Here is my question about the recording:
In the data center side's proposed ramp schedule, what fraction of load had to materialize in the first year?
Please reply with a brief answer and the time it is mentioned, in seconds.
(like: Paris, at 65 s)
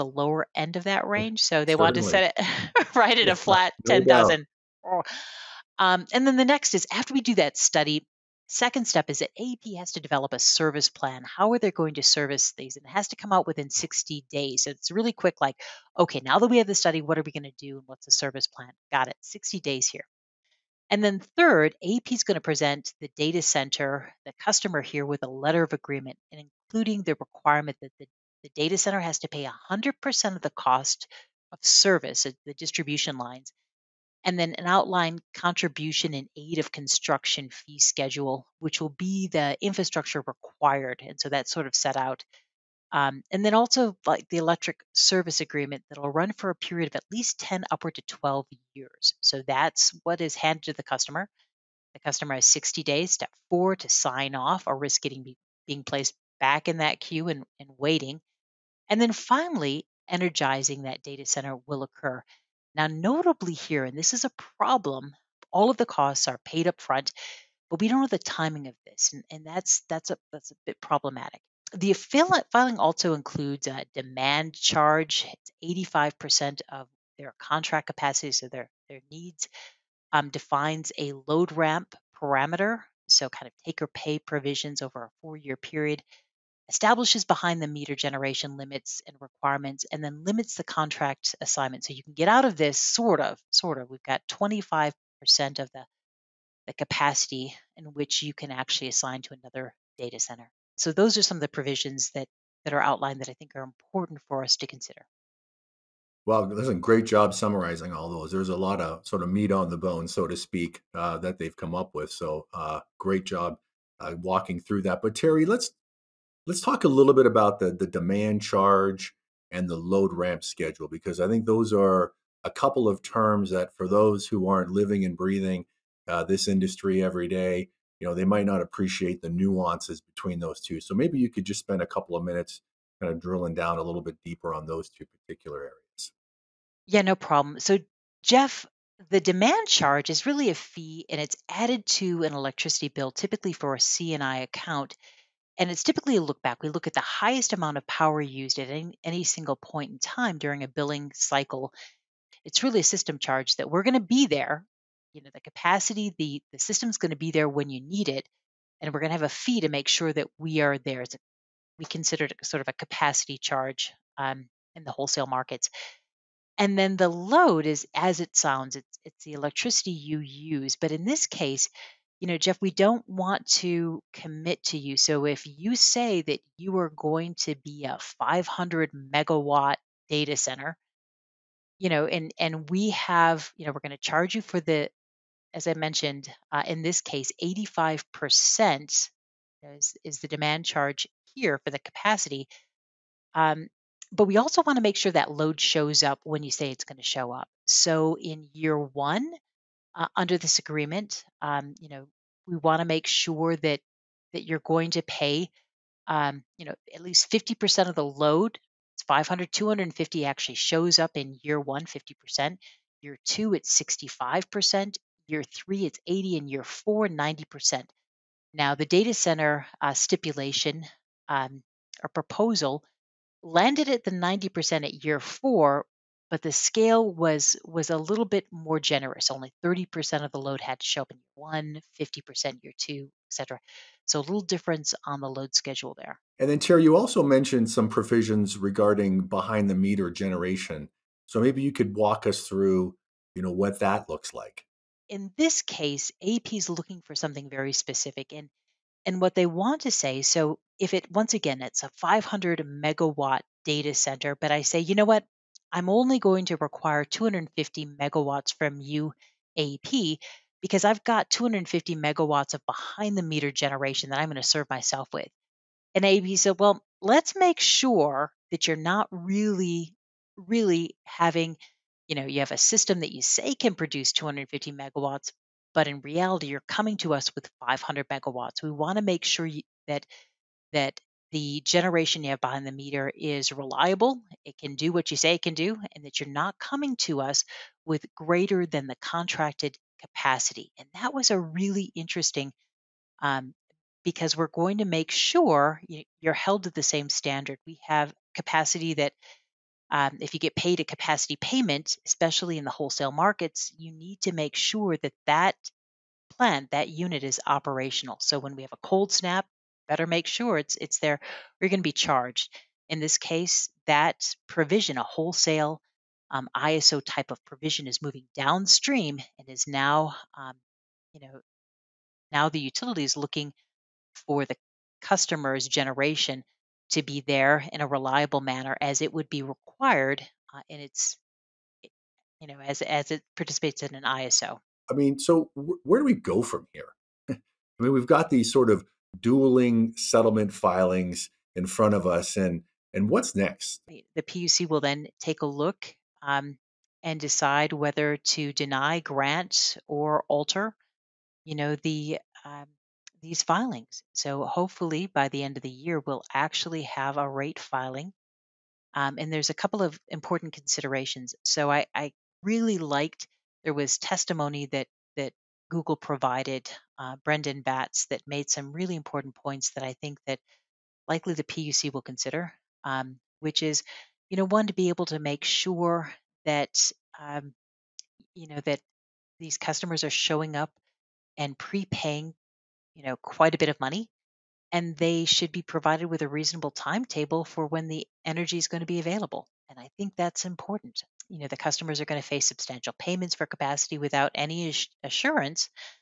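30%, at 229 s.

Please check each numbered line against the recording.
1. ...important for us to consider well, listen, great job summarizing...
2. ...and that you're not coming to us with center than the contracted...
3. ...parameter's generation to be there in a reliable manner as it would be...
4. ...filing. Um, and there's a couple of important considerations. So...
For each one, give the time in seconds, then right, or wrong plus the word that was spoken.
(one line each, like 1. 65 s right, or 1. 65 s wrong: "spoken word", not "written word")
1. 103 s right
2. 285 s wrong: "greater", not "center"
3. 325 s wrong: "customer", not "parameter"
4. 357 s right.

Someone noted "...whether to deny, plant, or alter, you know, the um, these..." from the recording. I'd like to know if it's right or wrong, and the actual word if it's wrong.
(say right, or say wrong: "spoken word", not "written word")
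wrong: "grant", not "plant".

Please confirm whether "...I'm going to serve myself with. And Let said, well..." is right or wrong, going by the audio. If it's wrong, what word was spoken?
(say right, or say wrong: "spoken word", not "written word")
wrong: "AEP", not "Let".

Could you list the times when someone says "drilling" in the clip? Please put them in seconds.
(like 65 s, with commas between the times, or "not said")
133 s.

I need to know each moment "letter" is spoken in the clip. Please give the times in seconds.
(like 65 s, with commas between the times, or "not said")
25 s.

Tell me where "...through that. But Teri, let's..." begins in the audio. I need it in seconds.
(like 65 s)
114 s.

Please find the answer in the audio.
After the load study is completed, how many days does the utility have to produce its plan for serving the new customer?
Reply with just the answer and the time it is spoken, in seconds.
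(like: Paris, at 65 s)
60 days, at 19 s.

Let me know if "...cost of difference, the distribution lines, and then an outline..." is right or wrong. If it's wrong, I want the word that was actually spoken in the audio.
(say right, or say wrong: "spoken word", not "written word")
wrong: "service", not "difference".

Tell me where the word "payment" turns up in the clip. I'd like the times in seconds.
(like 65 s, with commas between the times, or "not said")
301 s, 392 s.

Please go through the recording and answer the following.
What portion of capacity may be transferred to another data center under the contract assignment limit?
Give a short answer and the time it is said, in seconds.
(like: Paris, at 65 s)
25%, at 94 s.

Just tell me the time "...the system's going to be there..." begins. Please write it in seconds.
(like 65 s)
156 s.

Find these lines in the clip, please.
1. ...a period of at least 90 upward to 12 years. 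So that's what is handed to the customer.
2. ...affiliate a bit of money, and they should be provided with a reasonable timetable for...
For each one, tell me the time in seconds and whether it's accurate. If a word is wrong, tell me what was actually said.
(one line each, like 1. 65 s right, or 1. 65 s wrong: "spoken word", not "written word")
1. 46 s wrong: "10", not "90"
2. 383 s wrong: "quite", not "affiliate".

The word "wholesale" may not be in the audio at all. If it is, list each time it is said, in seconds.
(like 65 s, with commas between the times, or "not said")
164 s, 302 s, 315 s.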